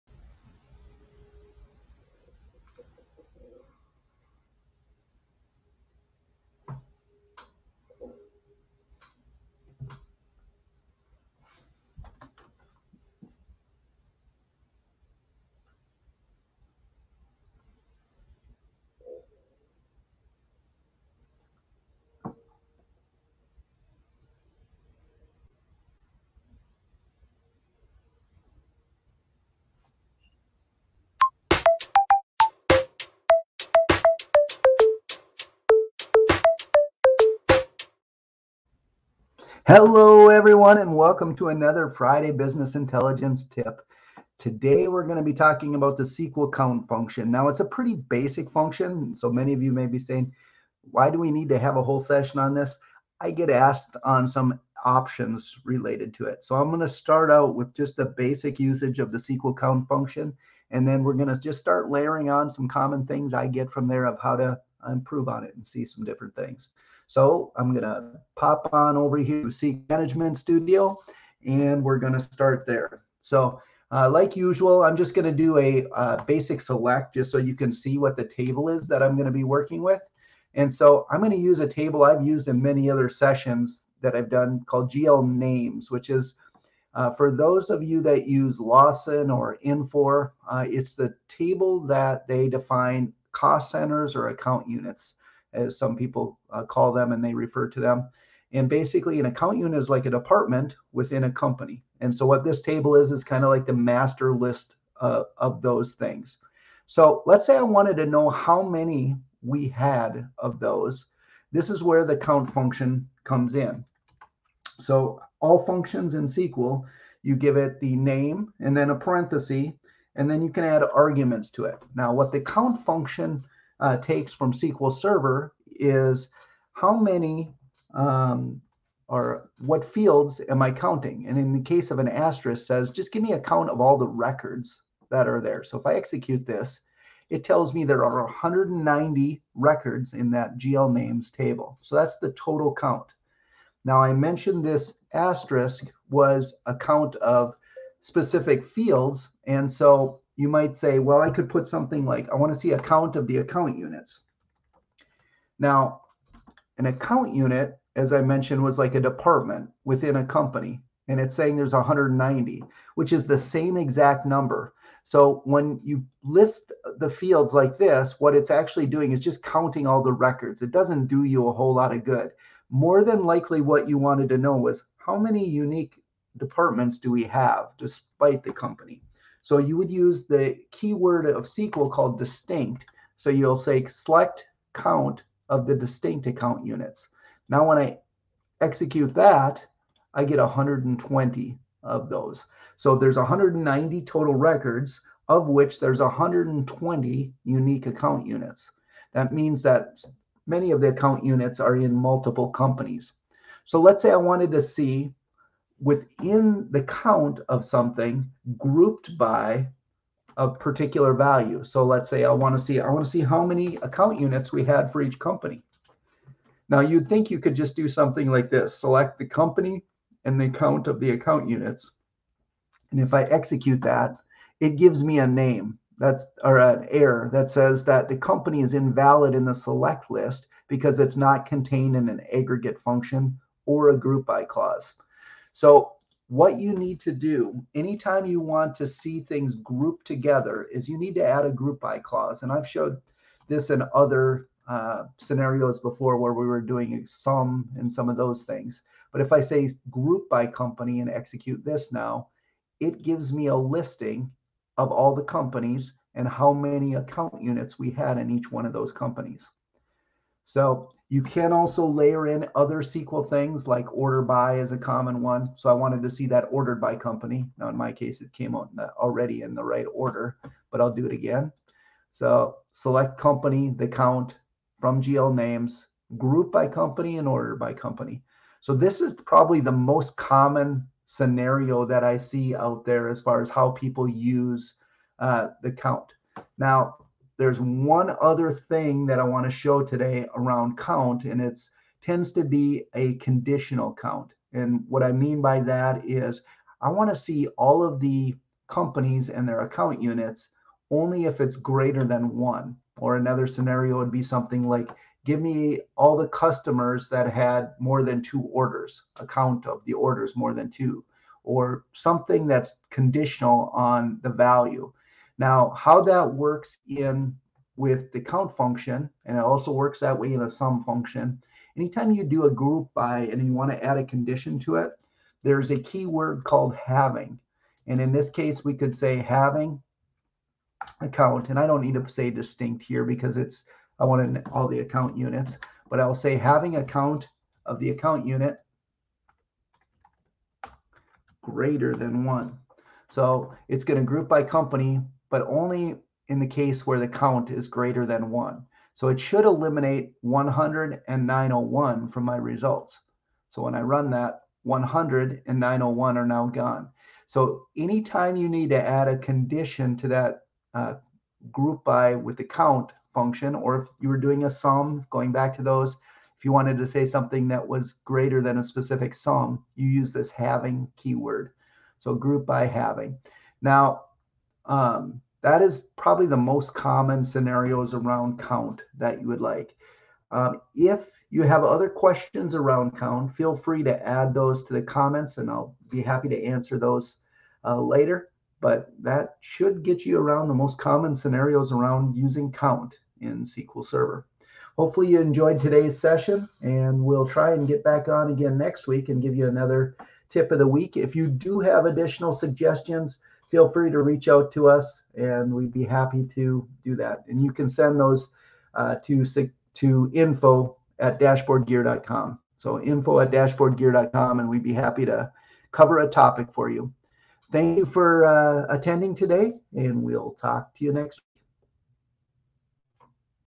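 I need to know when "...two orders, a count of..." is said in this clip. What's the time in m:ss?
5:08.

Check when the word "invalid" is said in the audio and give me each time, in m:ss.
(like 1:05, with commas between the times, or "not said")
3:48.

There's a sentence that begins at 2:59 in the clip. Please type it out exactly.
So you would use the keyword of SQL called distinct.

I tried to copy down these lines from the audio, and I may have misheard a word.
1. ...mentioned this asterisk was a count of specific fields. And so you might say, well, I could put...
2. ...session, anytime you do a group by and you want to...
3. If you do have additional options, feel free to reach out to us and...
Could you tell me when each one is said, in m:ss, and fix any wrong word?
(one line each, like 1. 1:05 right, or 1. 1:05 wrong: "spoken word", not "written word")
1. 2:24 right
2. 5:20 wrong: "function", not "session"
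3. 6:40 wrong: "suggestions", not "options".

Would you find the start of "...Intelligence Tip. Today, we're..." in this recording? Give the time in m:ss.
0:42.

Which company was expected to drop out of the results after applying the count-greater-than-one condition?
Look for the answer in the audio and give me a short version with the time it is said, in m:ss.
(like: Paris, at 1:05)
10901, at 5:50.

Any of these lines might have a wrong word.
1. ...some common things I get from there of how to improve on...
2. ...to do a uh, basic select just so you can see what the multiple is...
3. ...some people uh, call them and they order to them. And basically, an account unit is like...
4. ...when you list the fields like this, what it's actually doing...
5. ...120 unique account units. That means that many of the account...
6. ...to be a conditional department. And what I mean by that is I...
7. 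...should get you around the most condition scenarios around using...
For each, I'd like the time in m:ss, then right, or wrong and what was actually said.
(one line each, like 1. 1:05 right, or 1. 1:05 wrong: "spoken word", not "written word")
1. 1:02 right
2. 1:15 wrong: "table", not "multiple"
3. 1:35 wrong: "refer", not "order"
4. 2:45 right
5. 3:16 right
6. 4:52 wrong: "count", not "department"
7. 6:29 wrong: "common", not "condition".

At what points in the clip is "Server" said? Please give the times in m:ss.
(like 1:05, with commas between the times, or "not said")
2:04, 6:33.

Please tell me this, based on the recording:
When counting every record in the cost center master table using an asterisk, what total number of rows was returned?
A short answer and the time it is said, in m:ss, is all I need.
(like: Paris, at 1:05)
190, at 2:18.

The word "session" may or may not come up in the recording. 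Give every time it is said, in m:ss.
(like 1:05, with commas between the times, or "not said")
0:51, 1:23, 6:35.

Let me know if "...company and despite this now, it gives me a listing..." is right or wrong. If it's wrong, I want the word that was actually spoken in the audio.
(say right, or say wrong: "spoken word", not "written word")
wrong: "execute", not "despite".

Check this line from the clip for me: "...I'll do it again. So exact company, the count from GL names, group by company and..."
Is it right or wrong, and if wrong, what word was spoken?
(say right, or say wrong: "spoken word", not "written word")
wrong: "select", not "exact".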